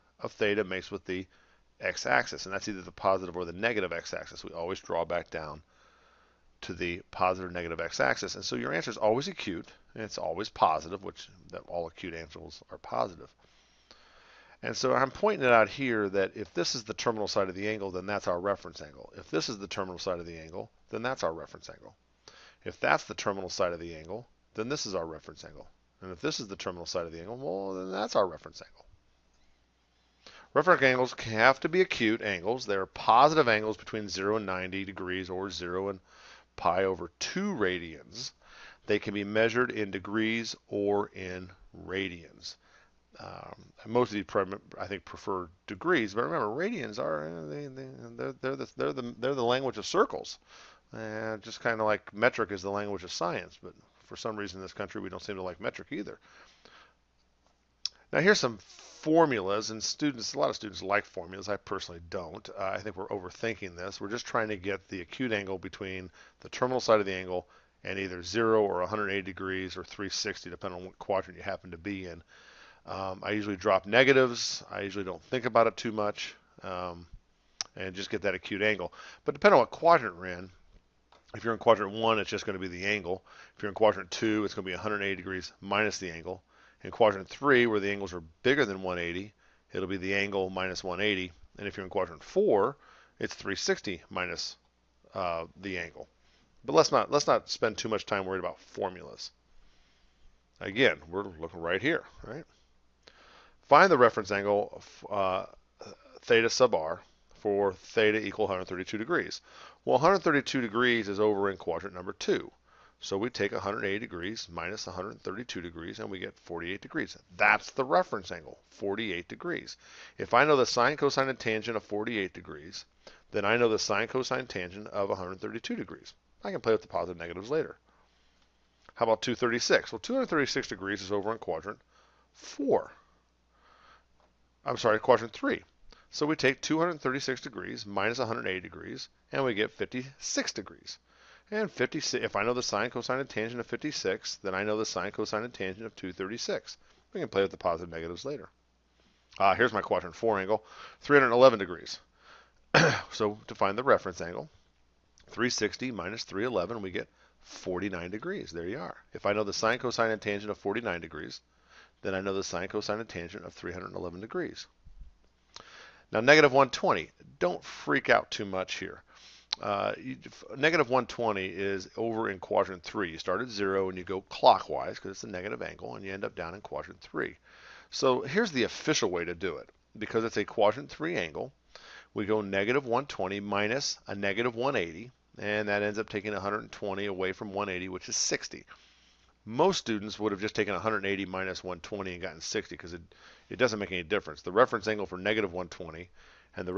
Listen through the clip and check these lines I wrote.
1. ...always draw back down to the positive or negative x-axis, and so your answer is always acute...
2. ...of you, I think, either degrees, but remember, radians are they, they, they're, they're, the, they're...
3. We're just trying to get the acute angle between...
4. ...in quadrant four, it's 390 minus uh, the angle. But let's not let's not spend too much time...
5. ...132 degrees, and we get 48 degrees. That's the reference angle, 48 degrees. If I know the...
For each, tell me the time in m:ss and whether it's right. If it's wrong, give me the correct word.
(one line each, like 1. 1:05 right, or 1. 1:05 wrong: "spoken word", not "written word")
1. 0:04 right
2. 0:44 wrong: "prefer", not "either"
3. 1:03 right
4. 1:31 wrong: "360", not "390"
5. 1:54 right.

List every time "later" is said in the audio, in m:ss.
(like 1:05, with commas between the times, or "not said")
2:07, 2:28.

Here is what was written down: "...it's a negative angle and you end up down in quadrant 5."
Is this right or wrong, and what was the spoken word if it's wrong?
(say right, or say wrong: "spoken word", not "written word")
wrong: "3", not "5".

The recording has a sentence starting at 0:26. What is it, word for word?
And if this is the terminal side of the angle, well, then that's our reference angle.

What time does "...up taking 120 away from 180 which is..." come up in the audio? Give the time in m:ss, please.
3:05.